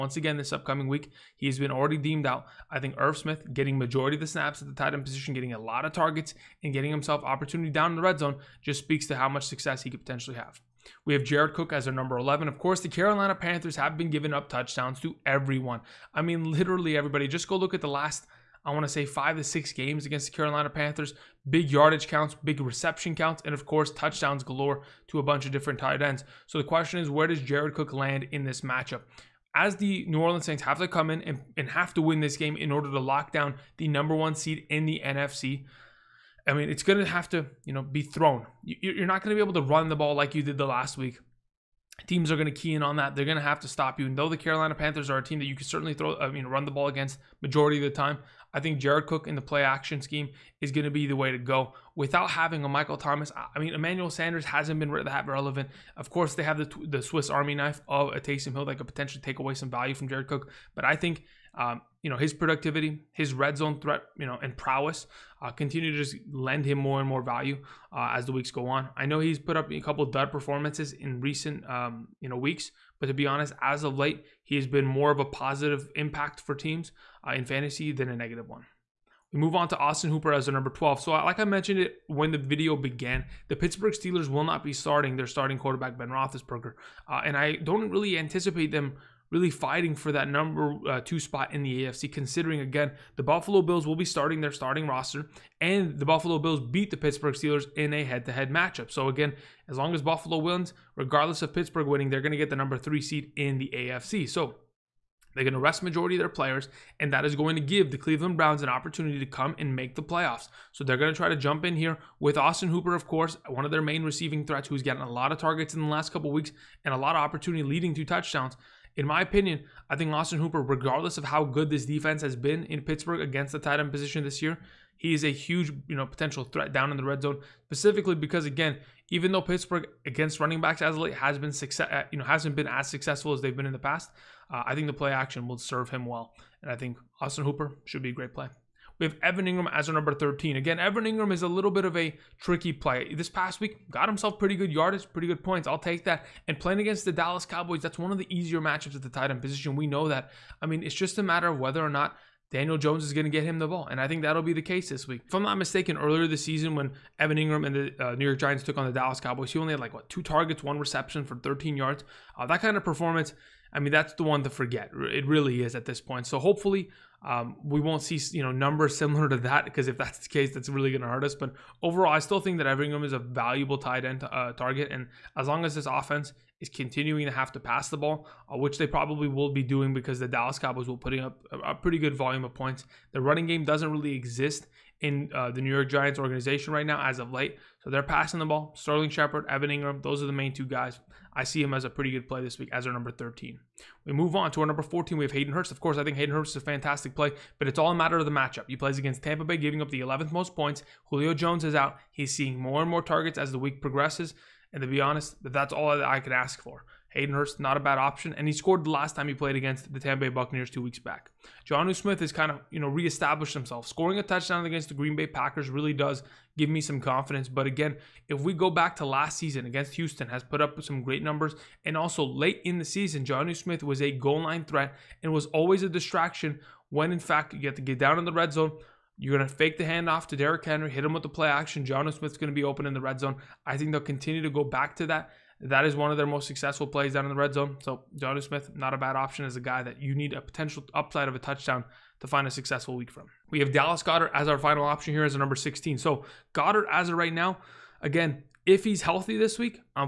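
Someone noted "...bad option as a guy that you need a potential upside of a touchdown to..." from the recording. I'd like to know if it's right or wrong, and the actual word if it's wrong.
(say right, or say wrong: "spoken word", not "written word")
right.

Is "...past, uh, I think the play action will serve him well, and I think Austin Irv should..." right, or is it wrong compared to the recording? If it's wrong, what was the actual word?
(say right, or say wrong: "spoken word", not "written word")
wrong: "Hooper", not "Irv".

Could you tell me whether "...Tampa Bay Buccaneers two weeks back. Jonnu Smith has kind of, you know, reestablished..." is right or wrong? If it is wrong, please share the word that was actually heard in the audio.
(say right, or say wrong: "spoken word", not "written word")
right.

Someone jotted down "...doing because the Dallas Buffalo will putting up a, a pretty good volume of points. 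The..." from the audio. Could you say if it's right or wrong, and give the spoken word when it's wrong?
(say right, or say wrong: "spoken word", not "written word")
wrong: "Cowboys", not "Buffalo".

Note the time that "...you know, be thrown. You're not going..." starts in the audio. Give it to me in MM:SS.
00:37.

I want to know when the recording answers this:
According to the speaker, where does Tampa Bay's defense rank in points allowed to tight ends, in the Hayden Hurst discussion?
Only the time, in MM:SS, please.
03:19.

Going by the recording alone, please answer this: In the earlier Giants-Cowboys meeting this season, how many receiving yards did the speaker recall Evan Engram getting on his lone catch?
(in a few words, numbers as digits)
13.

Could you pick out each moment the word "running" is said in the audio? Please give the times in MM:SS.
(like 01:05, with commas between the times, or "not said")
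02:10, 03:03.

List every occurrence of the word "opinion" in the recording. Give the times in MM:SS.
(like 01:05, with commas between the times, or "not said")
01:59.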